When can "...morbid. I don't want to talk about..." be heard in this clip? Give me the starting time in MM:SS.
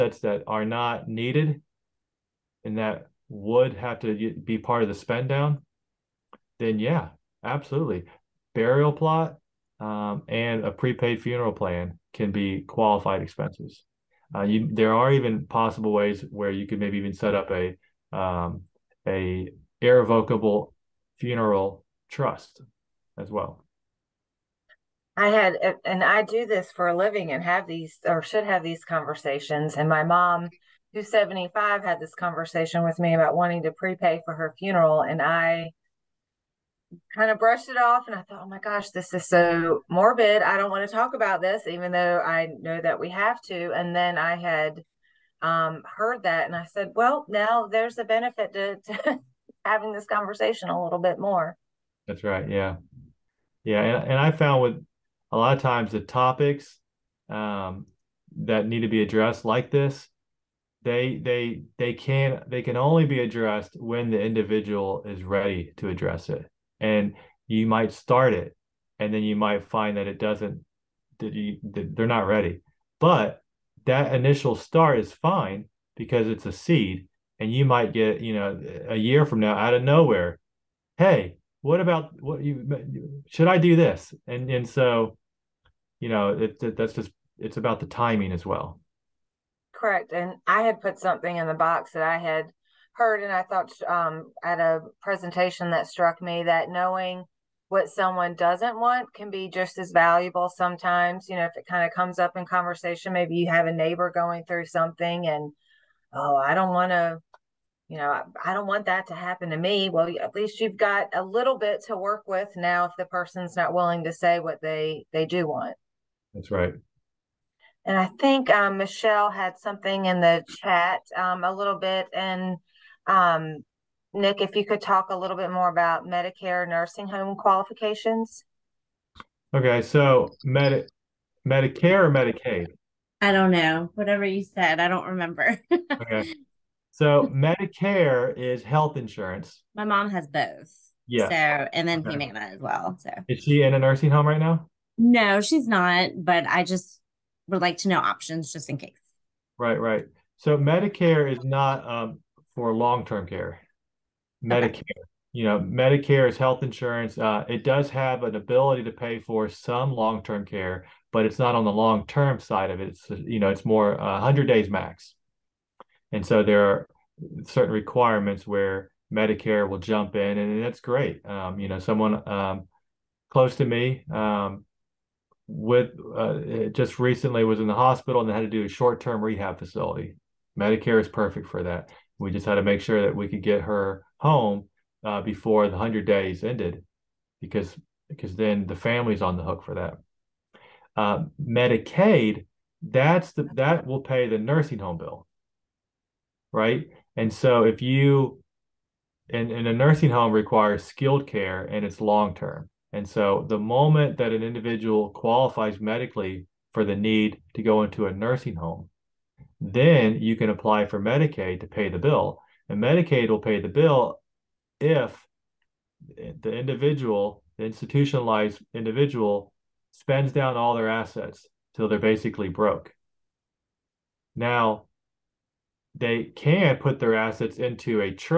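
00:39.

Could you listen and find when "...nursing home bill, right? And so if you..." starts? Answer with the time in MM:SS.
03:14.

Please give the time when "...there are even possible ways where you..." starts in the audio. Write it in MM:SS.
00:14.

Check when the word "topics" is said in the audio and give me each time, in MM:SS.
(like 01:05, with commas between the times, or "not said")
00:55.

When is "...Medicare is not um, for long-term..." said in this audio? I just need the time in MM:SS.
02:30.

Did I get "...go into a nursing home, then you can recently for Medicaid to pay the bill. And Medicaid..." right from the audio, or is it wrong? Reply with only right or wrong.
wrong.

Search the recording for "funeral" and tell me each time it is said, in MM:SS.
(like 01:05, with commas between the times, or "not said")
00:11, 00:21, 00:34.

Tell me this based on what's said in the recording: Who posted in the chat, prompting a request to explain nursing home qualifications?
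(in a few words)
Michelle.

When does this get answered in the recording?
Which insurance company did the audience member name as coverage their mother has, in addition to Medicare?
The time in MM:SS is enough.
02:22.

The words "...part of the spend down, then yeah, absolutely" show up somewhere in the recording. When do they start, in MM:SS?
00:04.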